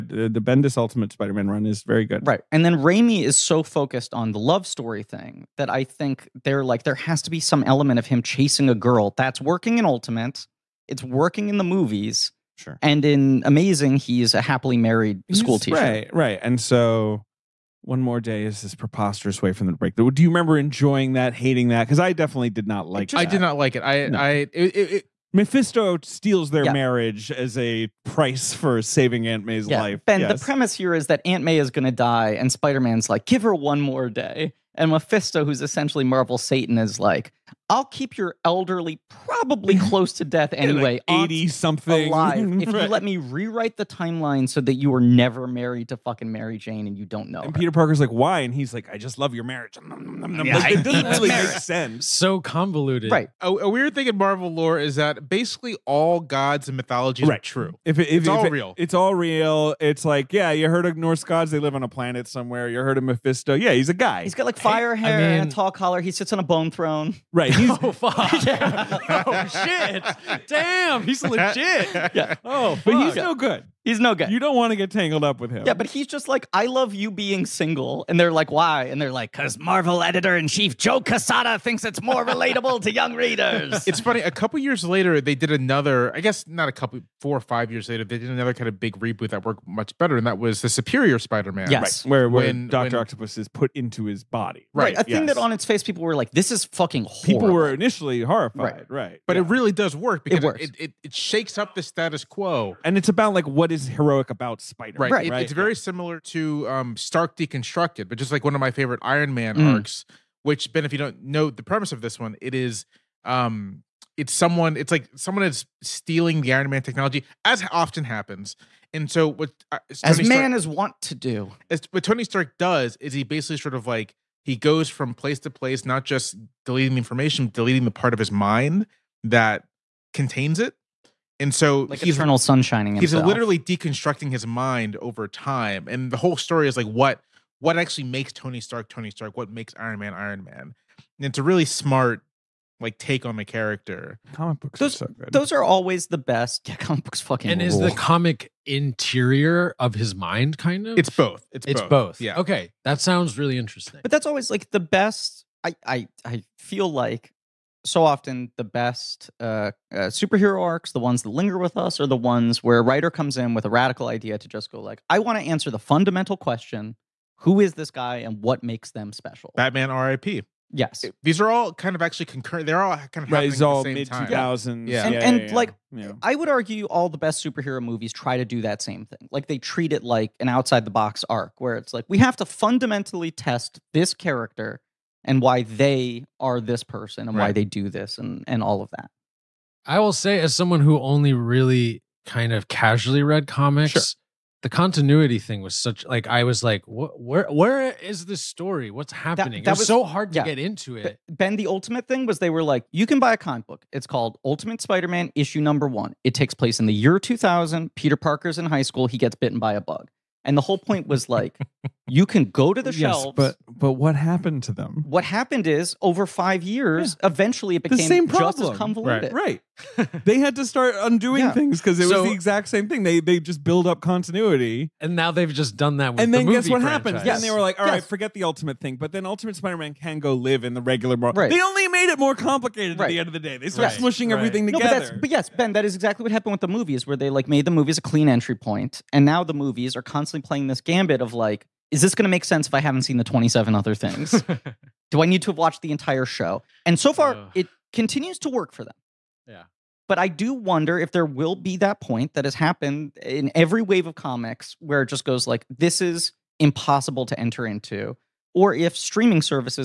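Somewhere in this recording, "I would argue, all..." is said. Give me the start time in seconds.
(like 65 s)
176 s.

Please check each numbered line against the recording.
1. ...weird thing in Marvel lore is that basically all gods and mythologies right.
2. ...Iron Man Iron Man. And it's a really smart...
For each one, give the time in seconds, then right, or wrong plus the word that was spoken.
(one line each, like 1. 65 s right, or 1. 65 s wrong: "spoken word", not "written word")
1. 53 s right
2. 139 s right.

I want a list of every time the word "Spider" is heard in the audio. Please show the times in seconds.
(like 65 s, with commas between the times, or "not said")
1 s, 32 s, 91 s, 104 s, 204 s, 229 s.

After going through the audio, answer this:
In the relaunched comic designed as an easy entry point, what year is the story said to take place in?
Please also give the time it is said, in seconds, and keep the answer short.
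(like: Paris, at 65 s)
2000, at 206 s.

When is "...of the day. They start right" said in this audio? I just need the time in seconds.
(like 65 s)
233 s.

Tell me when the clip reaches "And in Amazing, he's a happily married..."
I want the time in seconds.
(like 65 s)
12 s.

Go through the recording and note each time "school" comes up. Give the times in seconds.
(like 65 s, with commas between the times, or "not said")
15 s, 208 s.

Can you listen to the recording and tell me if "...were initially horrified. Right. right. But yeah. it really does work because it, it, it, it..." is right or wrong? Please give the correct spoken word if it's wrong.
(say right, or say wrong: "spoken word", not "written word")
right.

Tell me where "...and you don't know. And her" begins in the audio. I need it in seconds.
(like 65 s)
46 s.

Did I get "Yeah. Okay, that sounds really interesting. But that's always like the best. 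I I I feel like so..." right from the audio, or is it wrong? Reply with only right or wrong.
right.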